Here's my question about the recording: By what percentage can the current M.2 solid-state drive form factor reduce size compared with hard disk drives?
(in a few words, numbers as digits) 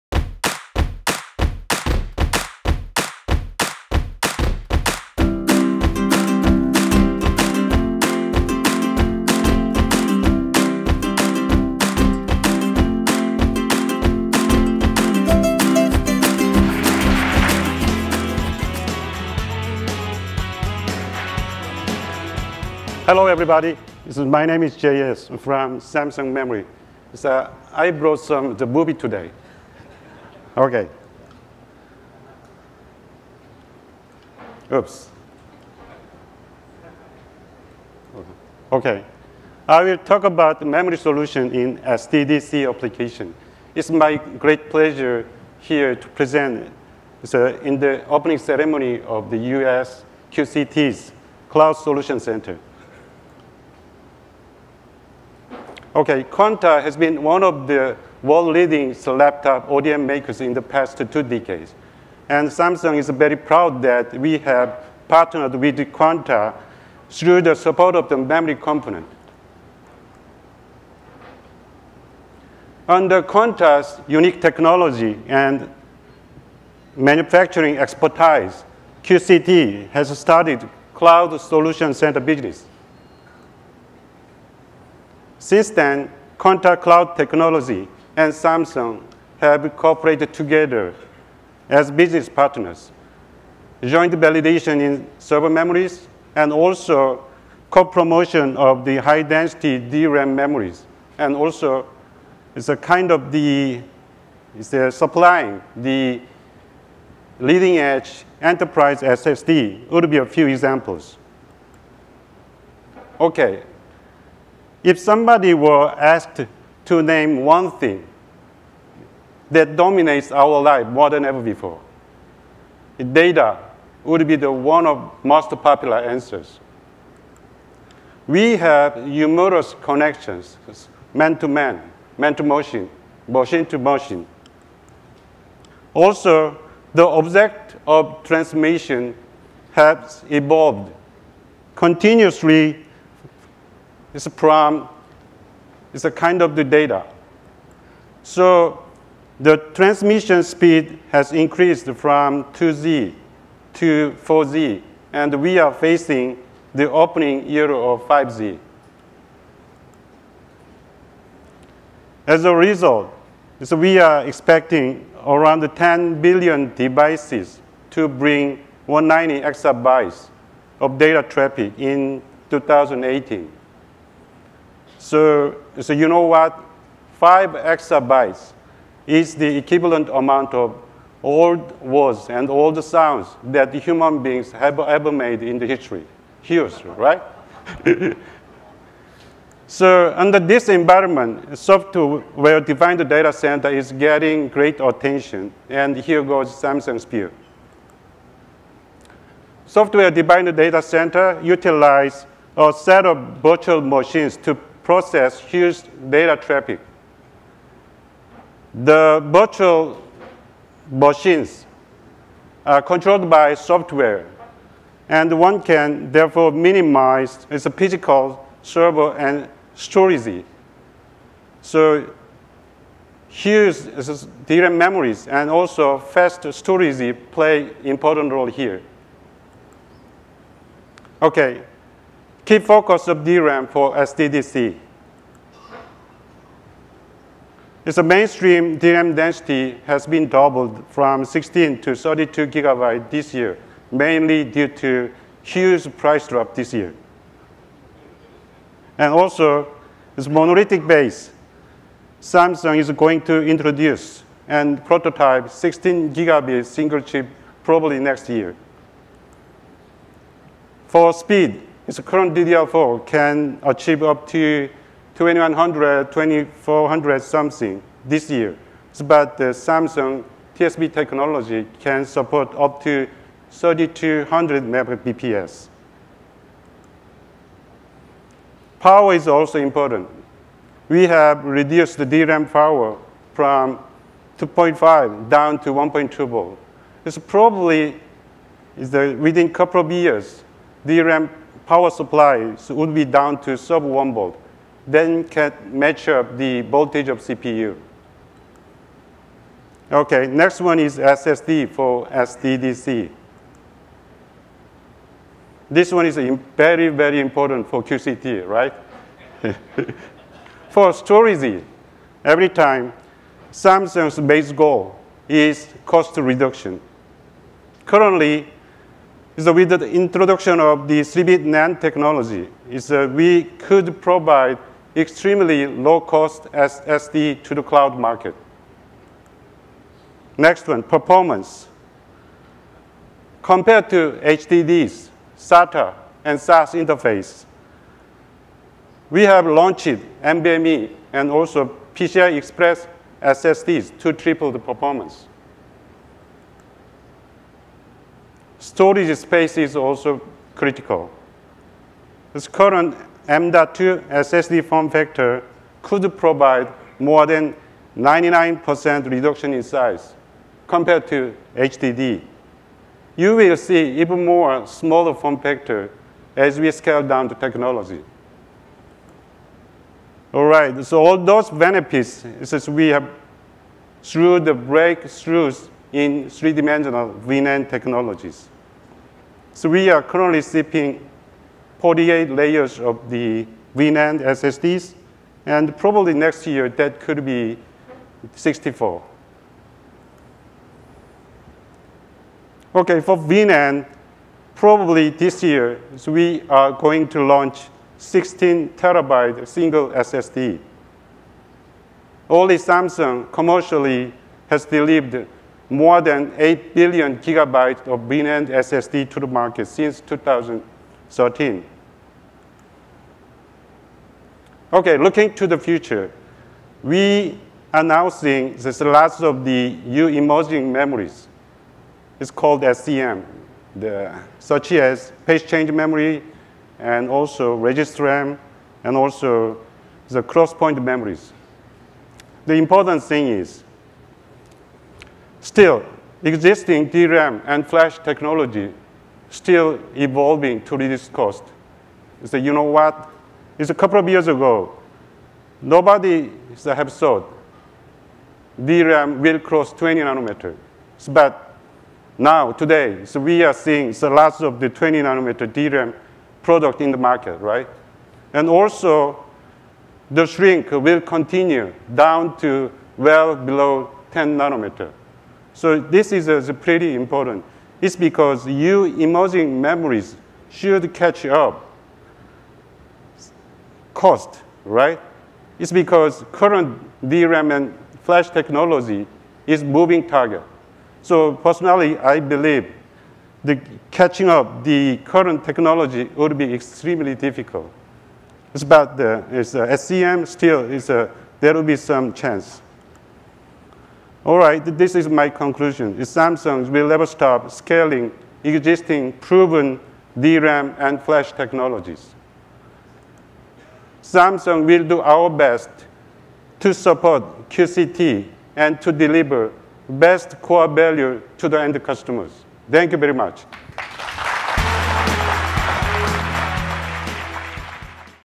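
more than 99%.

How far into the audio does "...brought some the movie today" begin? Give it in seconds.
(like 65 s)
27 s.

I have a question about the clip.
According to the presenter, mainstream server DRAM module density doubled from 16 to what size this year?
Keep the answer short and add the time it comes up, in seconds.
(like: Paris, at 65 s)
32 gigabyte, at 241 s.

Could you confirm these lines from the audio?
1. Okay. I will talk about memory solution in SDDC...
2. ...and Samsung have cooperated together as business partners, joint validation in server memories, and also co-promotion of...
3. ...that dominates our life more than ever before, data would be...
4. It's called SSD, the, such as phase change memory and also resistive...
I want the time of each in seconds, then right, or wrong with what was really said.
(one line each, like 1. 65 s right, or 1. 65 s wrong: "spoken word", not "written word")
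1. 38 s right
2. 88 s right
3. 119 s right
4. 422 s wrong: "SCM", not "SSD".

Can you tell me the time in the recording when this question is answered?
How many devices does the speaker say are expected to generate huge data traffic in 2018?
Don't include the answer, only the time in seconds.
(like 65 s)
165 s.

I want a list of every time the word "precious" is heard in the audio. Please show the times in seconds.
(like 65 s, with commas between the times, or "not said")
not said.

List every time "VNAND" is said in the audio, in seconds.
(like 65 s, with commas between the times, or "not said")
377 s, 383 s, 393 s, 408 s.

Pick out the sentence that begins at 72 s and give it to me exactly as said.
Under Quanta's unique technology and manufacturing expertise, QCT has started Cloud Solution Center business.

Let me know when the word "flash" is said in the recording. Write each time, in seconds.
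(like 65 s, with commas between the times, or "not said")
437 s, 478 s, 501 s.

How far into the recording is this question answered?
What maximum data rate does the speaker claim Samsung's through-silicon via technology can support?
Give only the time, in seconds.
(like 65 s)
273 s.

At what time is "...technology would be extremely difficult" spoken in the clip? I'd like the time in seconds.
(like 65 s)
485 s.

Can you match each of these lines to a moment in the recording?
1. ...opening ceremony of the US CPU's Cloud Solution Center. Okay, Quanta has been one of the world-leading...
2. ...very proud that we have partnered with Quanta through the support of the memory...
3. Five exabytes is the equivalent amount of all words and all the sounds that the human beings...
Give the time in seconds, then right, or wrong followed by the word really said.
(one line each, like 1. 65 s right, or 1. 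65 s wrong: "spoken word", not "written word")
1. 48 s wrong: "QCT", not "CPU"
2. 63 s right
3. 177 s right.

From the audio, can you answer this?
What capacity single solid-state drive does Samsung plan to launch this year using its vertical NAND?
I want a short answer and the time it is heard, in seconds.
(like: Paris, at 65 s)
16 terabyte, at 397 s.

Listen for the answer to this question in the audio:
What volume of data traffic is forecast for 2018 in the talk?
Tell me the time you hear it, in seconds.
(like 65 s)
168 s.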